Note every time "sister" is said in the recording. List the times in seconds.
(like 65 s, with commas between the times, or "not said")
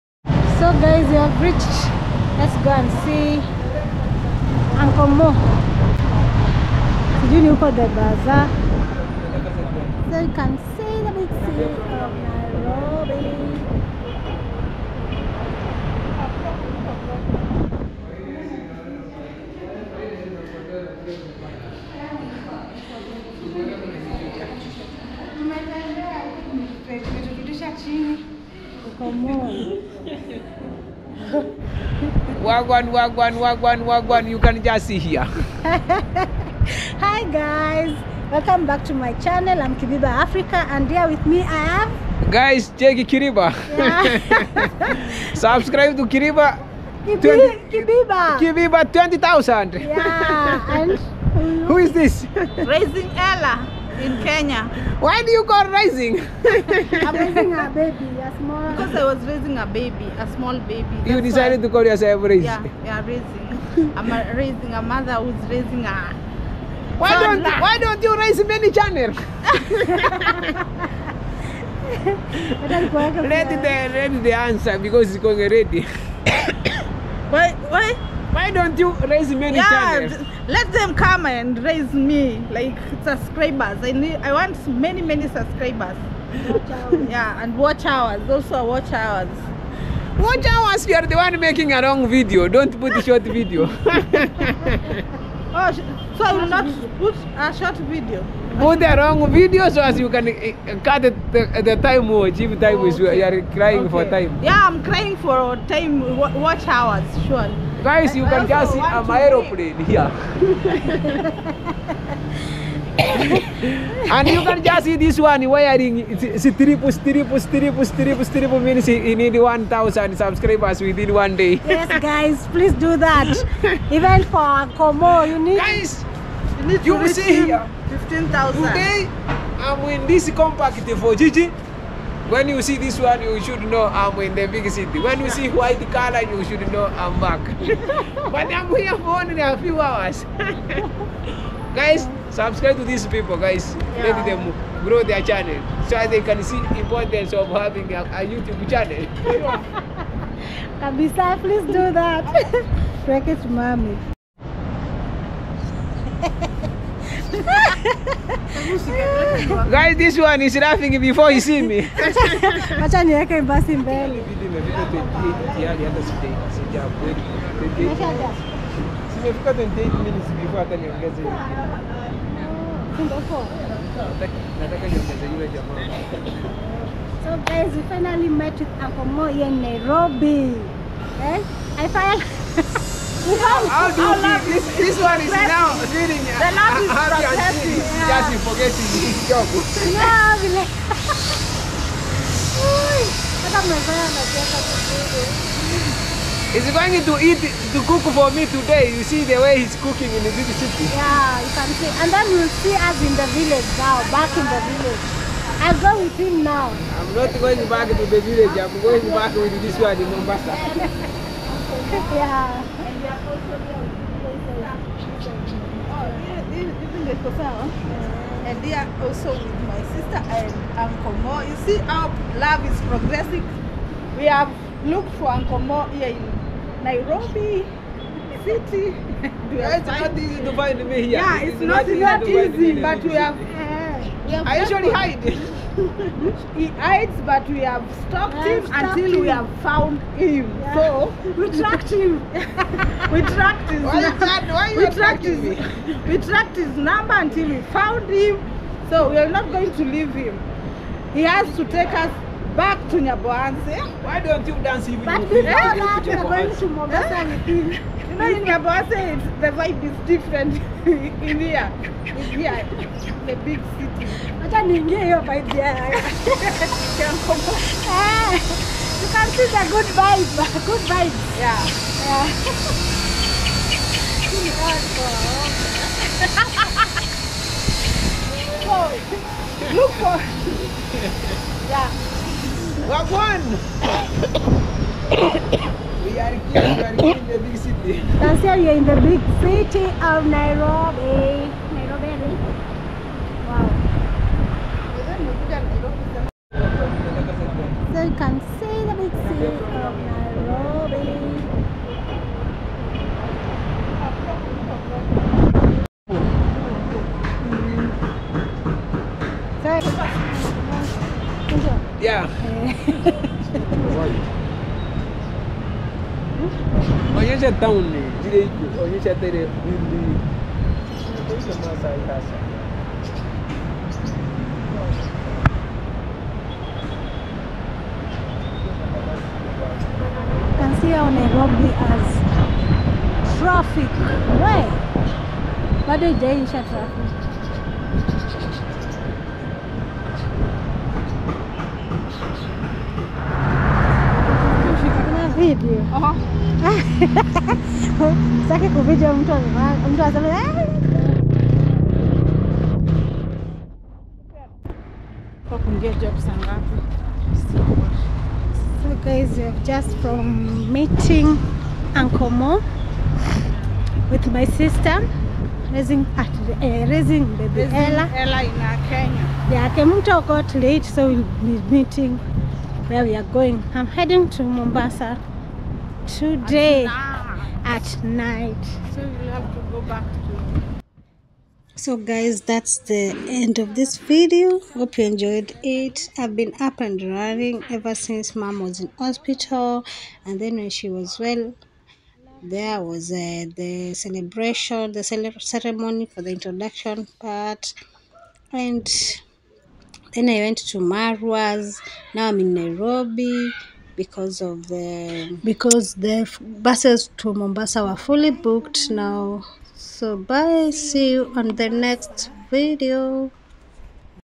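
219 s, 364 s.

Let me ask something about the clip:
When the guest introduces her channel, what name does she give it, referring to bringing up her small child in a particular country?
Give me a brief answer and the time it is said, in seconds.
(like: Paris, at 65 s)
Raising Ella in Kenya, at 52 s.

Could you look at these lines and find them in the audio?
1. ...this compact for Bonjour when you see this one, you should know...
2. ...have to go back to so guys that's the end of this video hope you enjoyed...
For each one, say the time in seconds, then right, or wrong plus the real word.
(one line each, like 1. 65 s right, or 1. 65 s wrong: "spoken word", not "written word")
1. 130 s wrong: "Gigi", not "Bonjour"
2. 379 s right.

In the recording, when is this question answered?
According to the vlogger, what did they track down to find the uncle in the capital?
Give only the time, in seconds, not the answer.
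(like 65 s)
246 s.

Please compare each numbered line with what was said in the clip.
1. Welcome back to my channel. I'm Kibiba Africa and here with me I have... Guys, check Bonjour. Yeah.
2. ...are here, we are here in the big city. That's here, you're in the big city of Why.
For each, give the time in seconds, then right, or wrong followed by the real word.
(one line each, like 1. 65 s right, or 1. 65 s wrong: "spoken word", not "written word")
1. 38 s wrong: "Kiriba", not "Bonjour"
2. 286 s wrong: "Nairobi", not "Why".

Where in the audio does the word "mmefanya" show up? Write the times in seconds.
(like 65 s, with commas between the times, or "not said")
193 s.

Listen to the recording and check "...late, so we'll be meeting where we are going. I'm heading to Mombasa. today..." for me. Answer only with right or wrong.
right.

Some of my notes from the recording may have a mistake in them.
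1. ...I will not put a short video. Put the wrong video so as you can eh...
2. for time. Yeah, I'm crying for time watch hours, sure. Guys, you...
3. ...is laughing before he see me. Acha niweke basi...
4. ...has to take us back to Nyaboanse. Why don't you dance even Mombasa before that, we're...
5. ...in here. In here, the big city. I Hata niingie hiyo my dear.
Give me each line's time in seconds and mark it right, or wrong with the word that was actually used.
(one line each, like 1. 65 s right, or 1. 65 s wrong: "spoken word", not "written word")
1. 96 s right
2. 103 s right
3. 160 s right
4. 251 s wrong: "But", not "Mombasa"
5. 260 s right.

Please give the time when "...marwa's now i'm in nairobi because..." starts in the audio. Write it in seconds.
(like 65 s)
400 s.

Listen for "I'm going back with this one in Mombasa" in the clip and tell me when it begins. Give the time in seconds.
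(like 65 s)
208 s.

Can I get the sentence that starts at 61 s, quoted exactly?
That's you decided why, to call yourself raising.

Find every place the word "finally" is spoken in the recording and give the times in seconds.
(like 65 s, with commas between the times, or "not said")
177 s, 181 s.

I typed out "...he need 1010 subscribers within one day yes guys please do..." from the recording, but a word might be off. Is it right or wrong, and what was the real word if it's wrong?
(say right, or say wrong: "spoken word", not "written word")
wrong: "1000", not "1010".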